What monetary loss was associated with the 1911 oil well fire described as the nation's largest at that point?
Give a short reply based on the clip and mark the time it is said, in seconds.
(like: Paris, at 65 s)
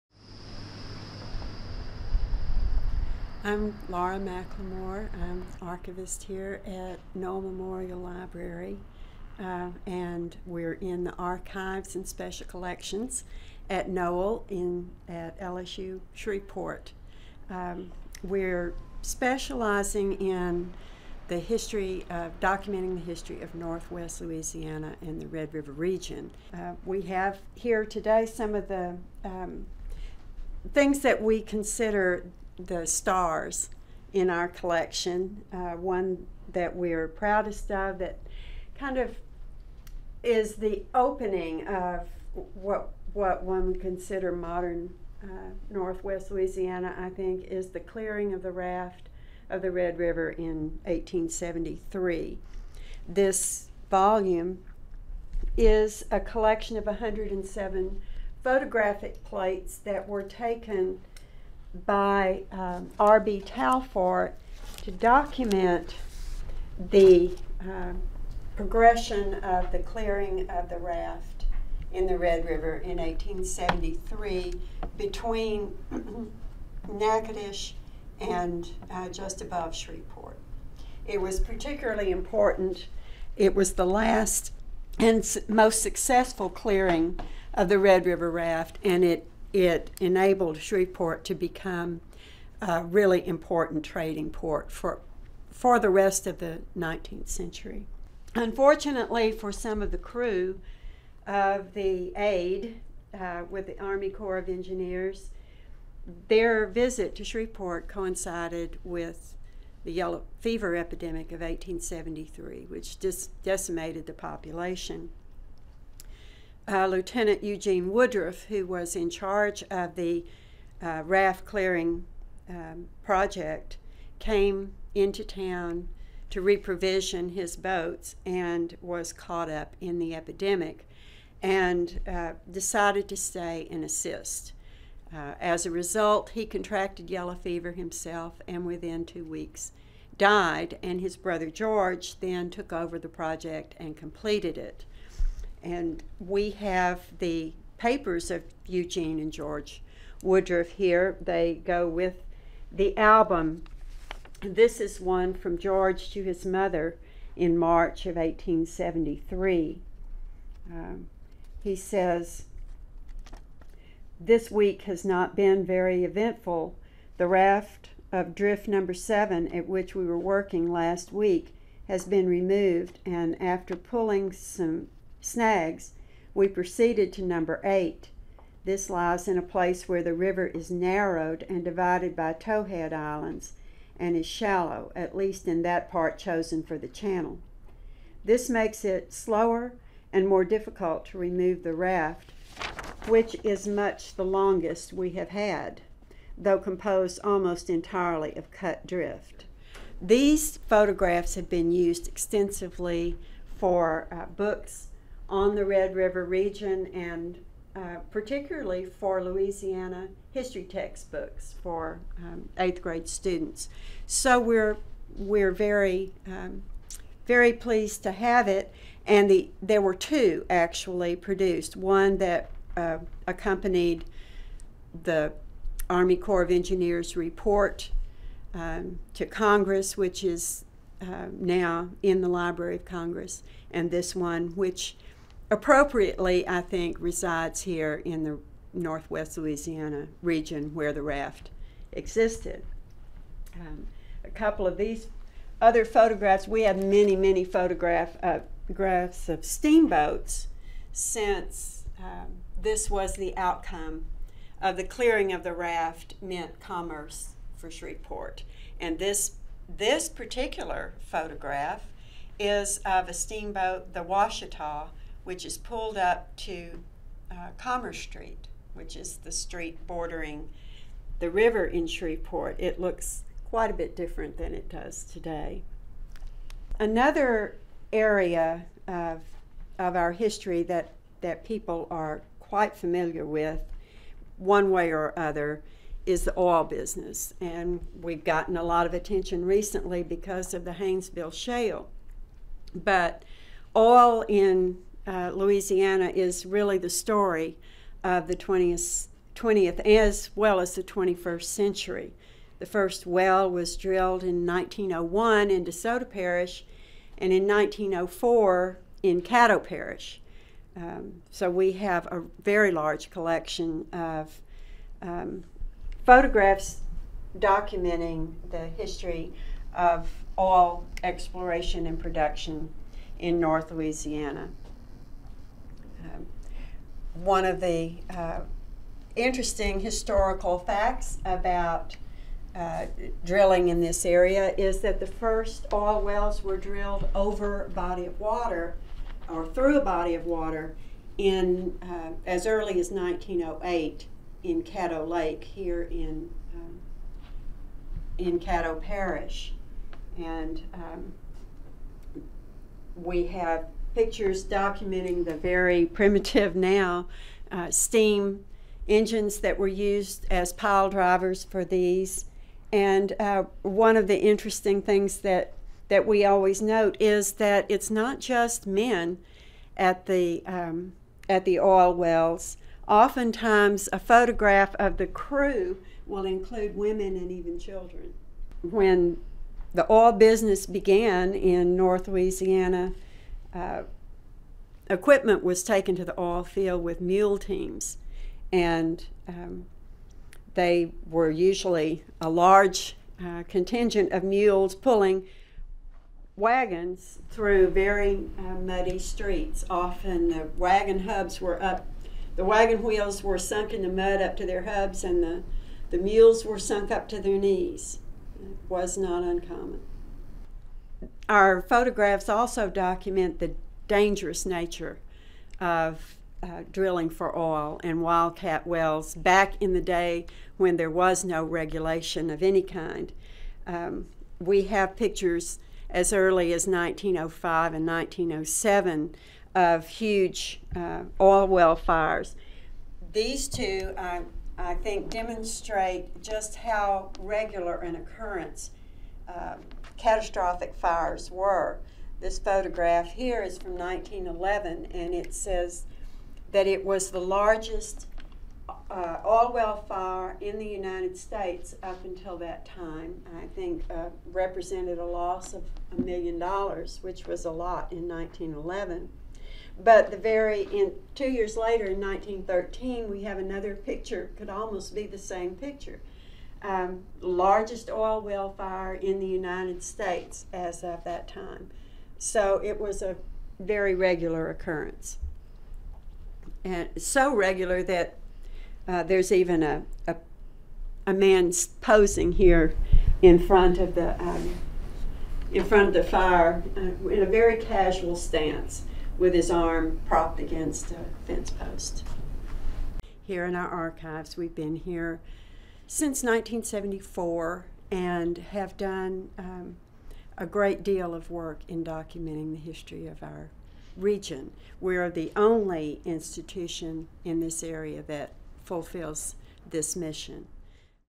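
a million dollars, at 455 s.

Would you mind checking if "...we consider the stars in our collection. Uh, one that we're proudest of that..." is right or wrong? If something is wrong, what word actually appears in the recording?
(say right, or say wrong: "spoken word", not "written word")
right.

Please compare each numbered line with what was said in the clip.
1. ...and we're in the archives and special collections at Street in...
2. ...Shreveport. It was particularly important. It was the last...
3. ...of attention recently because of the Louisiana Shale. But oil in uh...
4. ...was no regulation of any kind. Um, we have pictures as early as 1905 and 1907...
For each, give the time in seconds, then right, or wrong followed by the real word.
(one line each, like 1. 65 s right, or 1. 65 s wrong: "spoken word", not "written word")
1. 9 s wrong: "Noel", not "Street"
2. 79 s right
3. 288 s wrong: "Haynesville", not "Louisiana"
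4. 420 s right.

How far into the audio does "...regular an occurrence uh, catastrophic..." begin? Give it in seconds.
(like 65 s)
437 s.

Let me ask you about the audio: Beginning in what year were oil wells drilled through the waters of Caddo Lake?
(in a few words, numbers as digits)
1908.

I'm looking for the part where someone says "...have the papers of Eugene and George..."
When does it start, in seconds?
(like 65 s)
146 s.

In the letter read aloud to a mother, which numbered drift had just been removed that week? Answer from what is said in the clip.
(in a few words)
number seven.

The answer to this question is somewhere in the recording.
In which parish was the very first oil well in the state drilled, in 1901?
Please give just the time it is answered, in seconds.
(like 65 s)
305 s.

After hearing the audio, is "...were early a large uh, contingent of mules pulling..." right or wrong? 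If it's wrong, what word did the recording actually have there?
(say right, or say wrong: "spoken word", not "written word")
wrong: "usually", not "early".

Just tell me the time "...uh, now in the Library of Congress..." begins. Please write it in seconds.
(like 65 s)
231 s.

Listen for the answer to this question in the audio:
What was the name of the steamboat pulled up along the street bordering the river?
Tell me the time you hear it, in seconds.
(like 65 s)
264 s.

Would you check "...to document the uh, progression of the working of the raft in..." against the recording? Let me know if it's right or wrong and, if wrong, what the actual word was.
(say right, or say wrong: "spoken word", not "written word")
wrong: "clearing", not "working".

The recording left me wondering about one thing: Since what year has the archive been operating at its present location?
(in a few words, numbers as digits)
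1974.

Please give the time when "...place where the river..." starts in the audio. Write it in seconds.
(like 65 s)
179 s.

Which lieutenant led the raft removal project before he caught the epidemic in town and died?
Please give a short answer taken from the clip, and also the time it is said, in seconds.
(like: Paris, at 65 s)
Eugene Woodruff, at 117 s.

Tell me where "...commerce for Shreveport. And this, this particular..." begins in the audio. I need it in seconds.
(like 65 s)
256 s.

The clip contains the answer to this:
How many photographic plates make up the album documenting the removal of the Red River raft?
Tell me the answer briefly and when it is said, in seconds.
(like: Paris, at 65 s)
107, at 56 s.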